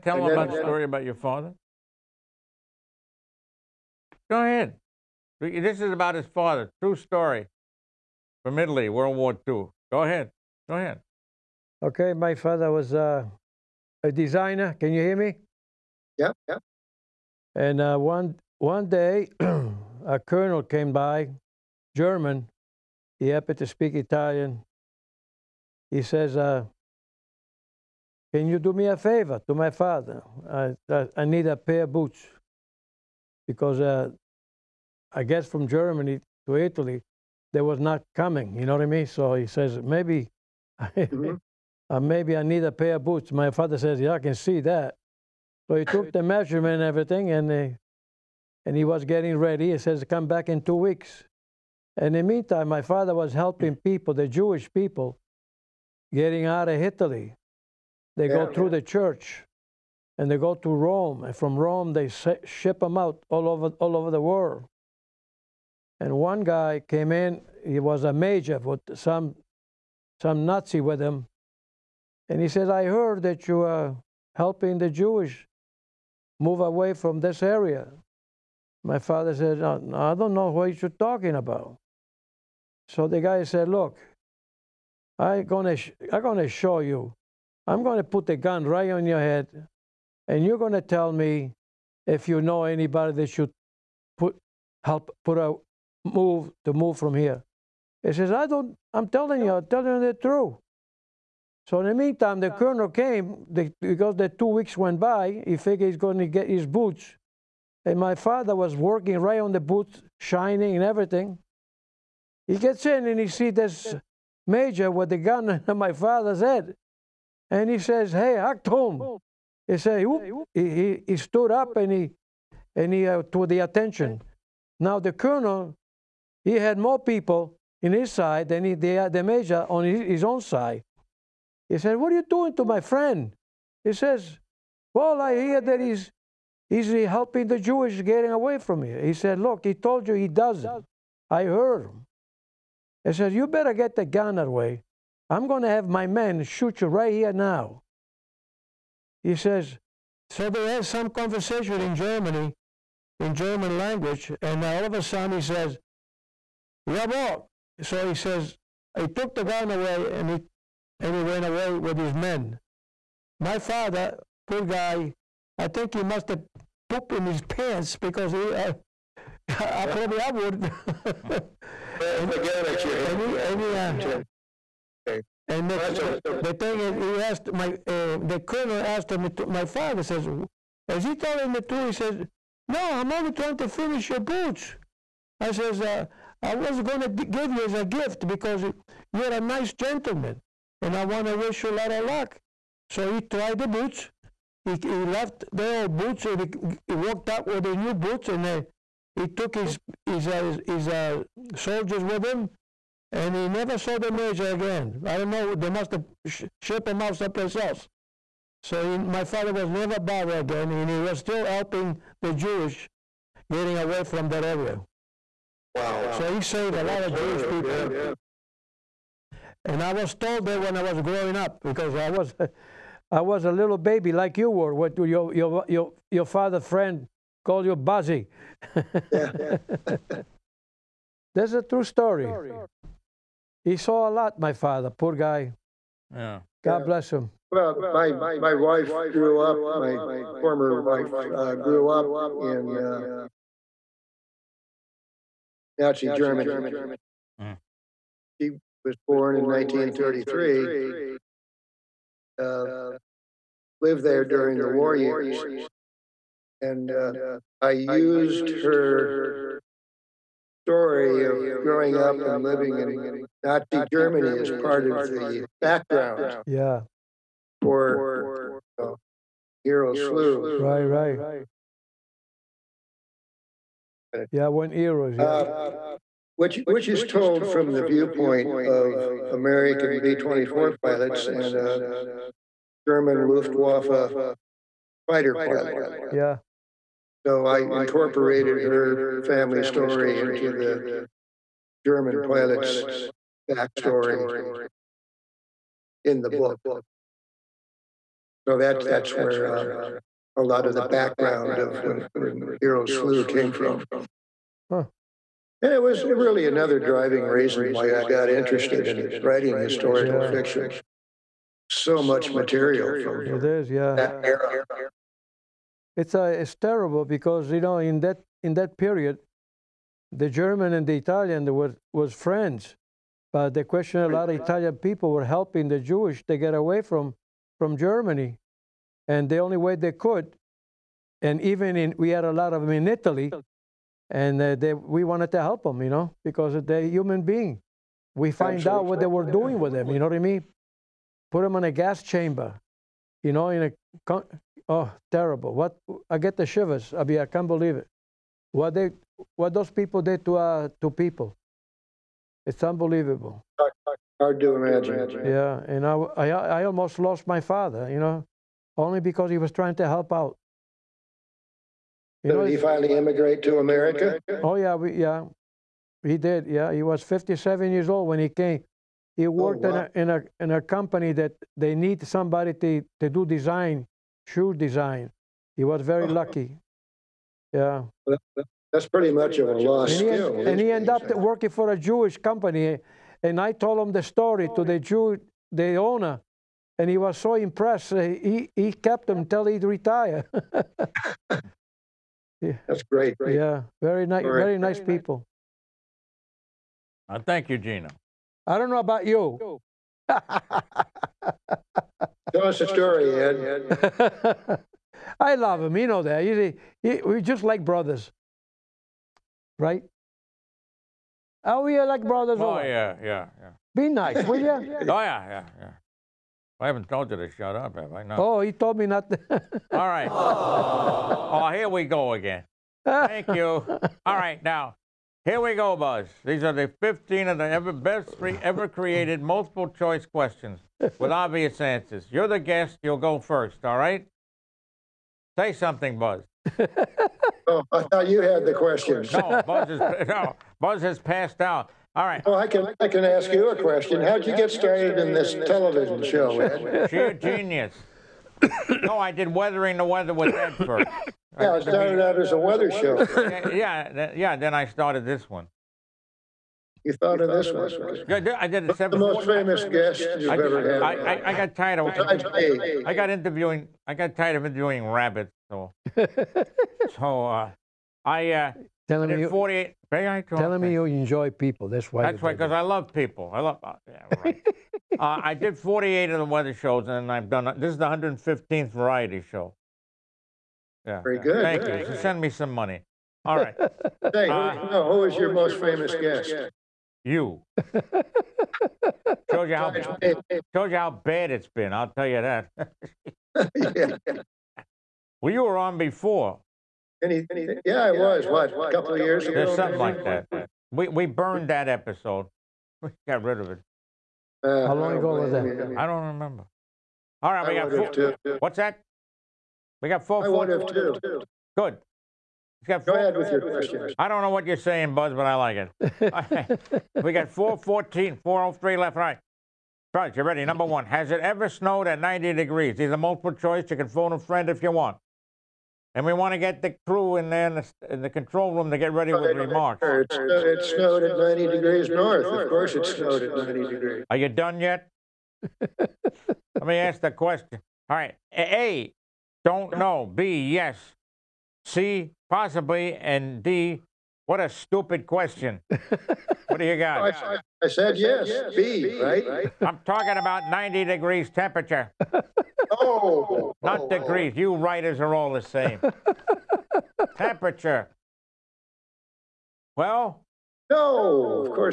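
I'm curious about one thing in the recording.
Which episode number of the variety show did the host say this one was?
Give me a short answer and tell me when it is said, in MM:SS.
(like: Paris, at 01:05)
115th, at 07:57.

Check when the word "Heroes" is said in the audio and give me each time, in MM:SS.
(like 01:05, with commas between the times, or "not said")
04:29, 05:02.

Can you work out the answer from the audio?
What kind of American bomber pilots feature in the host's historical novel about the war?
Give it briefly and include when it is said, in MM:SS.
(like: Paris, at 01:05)
B-24, at 04:40.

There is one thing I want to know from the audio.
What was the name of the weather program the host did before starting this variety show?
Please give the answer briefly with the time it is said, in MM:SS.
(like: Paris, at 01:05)
Weathering the Weather with Ed, at 07:29.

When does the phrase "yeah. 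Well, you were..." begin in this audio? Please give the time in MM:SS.
08:13.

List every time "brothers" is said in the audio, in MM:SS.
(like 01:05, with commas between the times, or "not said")
06:47, 06:52.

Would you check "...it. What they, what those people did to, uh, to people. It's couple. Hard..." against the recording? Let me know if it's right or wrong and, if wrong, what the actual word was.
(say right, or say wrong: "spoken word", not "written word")
wrong: "unbelievable", not "couple".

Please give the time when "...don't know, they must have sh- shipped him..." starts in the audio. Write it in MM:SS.
03:25.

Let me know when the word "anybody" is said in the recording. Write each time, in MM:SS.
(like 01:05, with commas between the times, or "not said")
01:32.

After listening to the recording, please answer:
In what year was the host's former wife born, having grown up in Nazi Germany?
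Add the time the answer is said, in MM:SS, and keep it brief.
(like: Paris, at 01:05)
1933, at 04:09.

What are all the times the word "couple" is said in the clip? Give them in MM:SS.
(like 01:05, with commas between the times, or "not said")
08:18.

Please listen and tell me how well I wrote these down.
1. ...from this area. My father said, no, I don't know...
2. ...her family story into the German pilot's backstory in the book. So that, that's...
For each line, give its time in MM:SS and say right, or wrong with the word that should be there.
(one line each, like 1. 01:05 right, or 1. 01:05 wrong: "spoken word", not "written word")
1. 01:16 right
2. 04:48 right.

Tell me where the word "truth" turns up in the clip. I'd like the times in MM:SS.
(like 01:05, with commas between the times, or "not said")
01:40, 03:01.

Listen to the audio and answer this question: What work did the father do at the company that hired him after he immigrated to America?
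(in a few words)
Shoe design.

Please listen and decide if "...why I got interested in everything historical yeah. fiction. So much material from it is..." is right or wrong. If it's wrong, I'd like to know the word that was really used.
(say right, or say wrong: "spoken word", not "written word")
wrong: "writing", not "everything".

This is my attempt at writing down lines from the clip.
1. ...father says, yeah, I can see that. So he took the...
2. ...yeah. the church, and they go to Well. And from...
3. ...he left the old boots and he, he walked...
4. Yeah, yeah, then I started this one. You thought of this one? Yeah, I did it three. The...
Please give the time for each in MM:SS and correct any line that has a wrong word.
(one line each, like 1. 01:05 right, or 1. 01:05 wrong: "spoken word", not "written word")
1. 00:43 right
2. 00:58 wrong: "Rome", not "Well"
3. 03:14 right
4. 07:33 wrong: "seven", not "three".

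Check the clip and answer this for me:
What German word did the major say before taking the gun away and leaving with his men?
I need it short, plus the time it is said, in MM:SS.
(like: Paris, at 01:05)
Jawohl, at 02:36.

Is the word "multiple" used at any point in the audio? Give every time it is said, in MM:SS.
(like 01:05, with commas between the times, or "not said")
07:09, 08:42.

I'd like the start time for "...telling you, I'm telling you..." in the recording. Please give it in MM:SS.
01:39.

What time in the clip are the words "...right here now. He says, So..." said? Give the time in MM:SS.
02:26.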